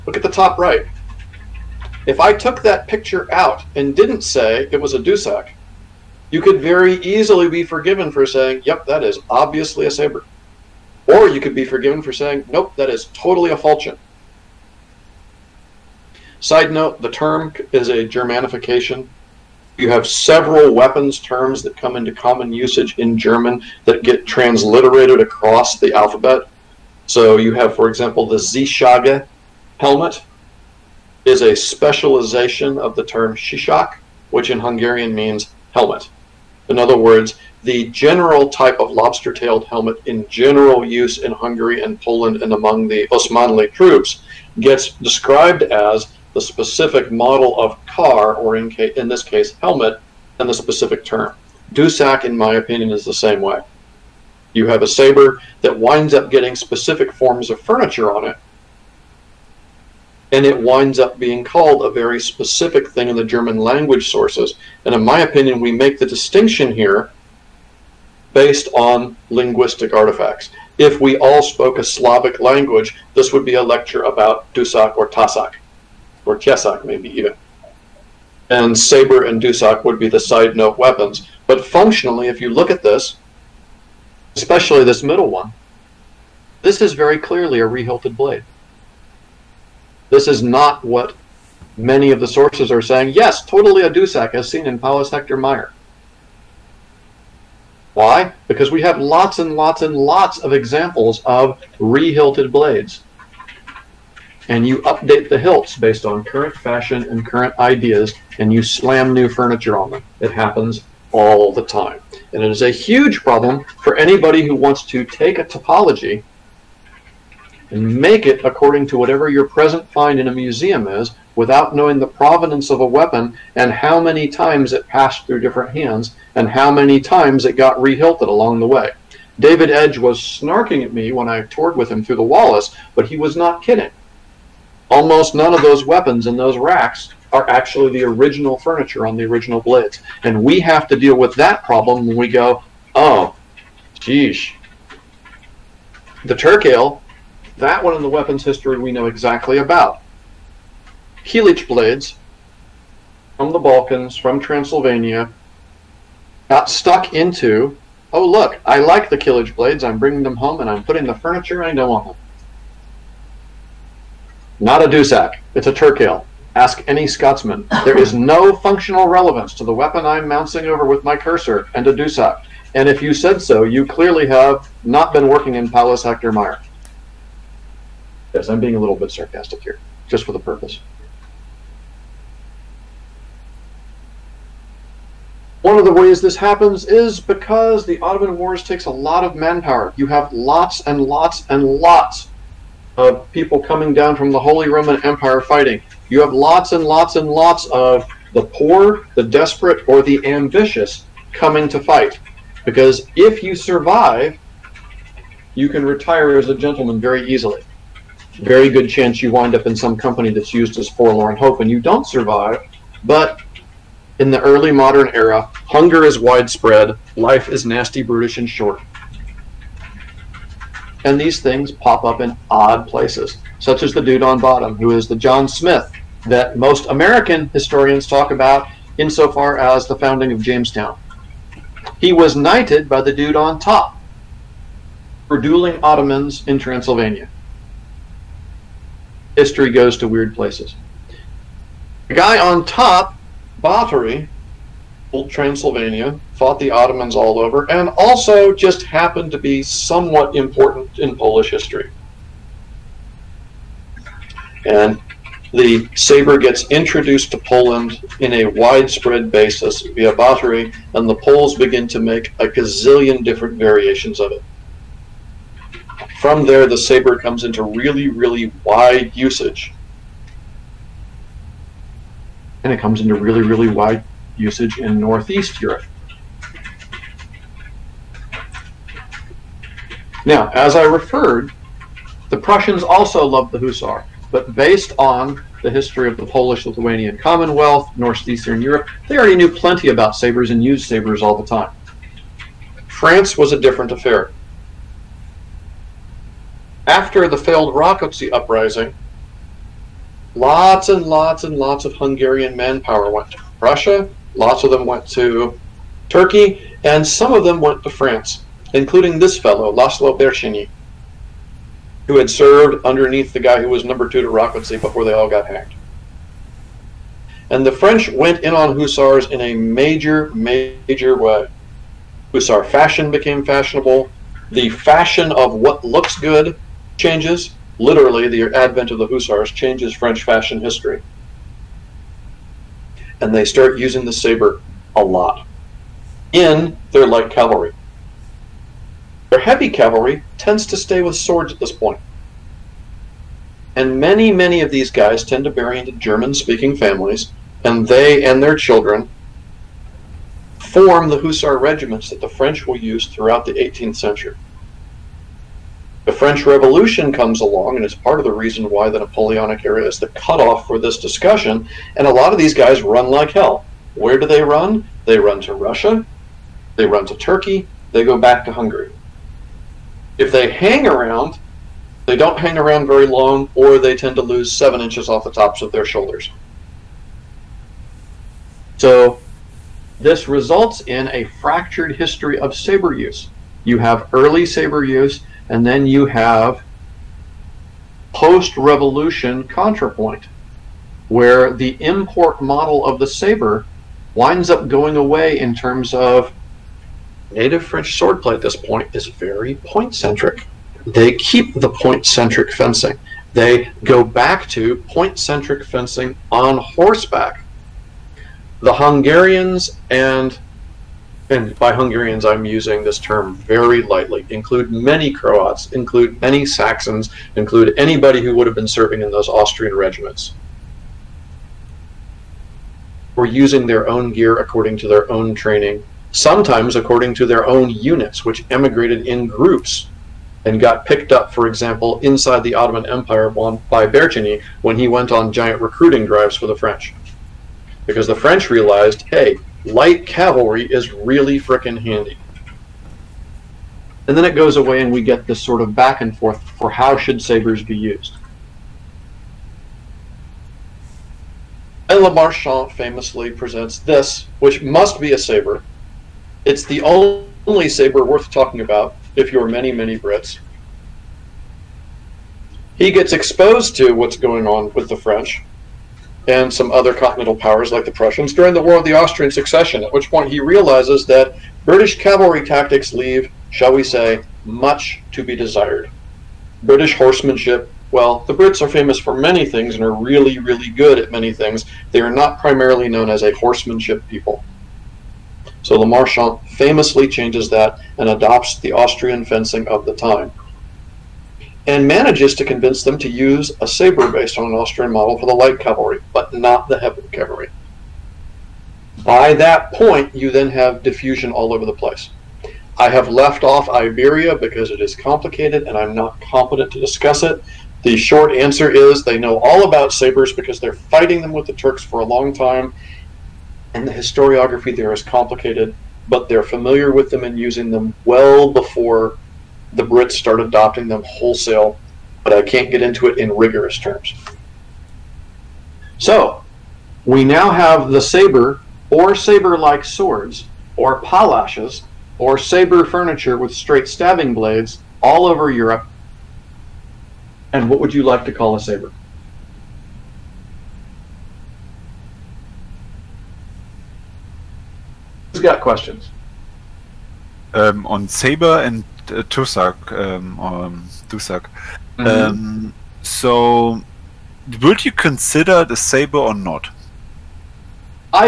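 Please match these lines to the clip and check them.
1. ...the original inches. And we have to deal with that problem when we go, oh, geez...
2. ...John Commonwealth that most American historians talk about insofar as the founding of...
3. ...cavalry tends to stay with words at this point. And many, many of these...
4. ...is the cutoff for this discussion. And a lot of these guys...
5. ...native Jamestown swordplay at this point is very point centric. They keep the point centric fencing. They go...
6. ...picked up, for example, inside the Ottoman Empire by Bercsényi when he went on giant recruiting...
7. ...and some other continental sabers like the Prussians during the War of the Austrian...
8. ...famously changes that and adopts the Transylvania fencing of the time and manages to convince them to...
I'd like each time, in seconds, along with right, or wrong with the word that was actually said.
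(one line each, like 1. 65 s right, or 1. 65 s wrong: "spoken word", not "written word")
1. 139 s wrong: "blades", not "inches"
2. 225 s wrong: "Smith", not "Commonwealth"
3. 339 s wrong: "swords", not "words"
4. 359 s right
5. 397 s wrong: "French", not "Jamestown"
6. 430 s right
7. 466 s wrong: "powers", not "sabers"
8. 486 s wrong: "Austrian", not "Transylvania".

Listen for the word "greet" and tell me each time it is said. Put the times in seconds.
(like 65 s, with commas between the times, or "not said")
not said.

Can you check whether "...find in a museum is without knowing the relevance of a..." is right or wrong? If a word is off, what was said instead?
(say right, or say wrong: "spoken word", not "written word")
wrong: "provenance", not "relevance".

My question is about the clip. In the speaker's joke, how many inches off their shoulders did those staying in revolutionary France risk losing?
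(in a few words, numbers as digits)
7.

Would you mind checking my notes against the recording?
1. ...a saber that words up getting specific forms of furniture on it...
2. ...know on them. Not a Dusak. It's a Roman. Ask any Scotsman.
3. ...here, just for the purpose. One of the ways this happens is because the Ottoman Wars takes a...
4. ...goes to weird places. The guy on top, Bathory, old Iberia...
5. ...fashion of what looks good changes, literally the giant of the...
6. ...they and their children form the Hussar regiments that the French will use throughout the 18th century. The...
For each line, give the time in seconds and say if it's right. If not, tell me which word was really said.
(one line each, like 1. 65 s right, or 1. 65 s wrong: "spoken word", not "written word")
1. 54 s wrong: "winds", not "words"
2. 161 s wrong: "Turkale", not "Roman"
3. 179 s right
4. 239 s wrong: "Transylvania", not "Iberia"
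5. 324 s wrong: "advent", not "giant"
6. 347 s right.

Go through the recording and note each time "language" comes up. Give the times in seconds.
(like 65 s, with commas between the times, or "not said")
63 s, 72 s.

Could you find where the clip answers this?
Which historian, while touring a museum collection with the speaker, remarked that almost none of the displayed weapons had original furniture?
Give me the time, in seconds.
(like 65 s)
129 s.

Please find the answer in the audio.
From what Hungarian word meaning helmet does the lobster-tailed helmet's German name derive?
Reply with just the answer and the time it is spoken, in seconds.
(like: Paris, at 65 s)
Shishak, at 33 s.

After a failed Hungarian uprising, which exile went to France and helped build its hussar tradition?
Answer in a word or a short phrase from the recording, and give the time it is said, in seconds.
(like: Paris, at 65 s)
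Laszlo Bercsényi, at 309 s.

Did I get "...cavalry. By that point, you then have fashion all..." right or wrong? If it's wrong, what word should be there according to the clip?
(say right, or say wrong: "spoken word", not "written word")
wrong: "diffusion", not "fashion".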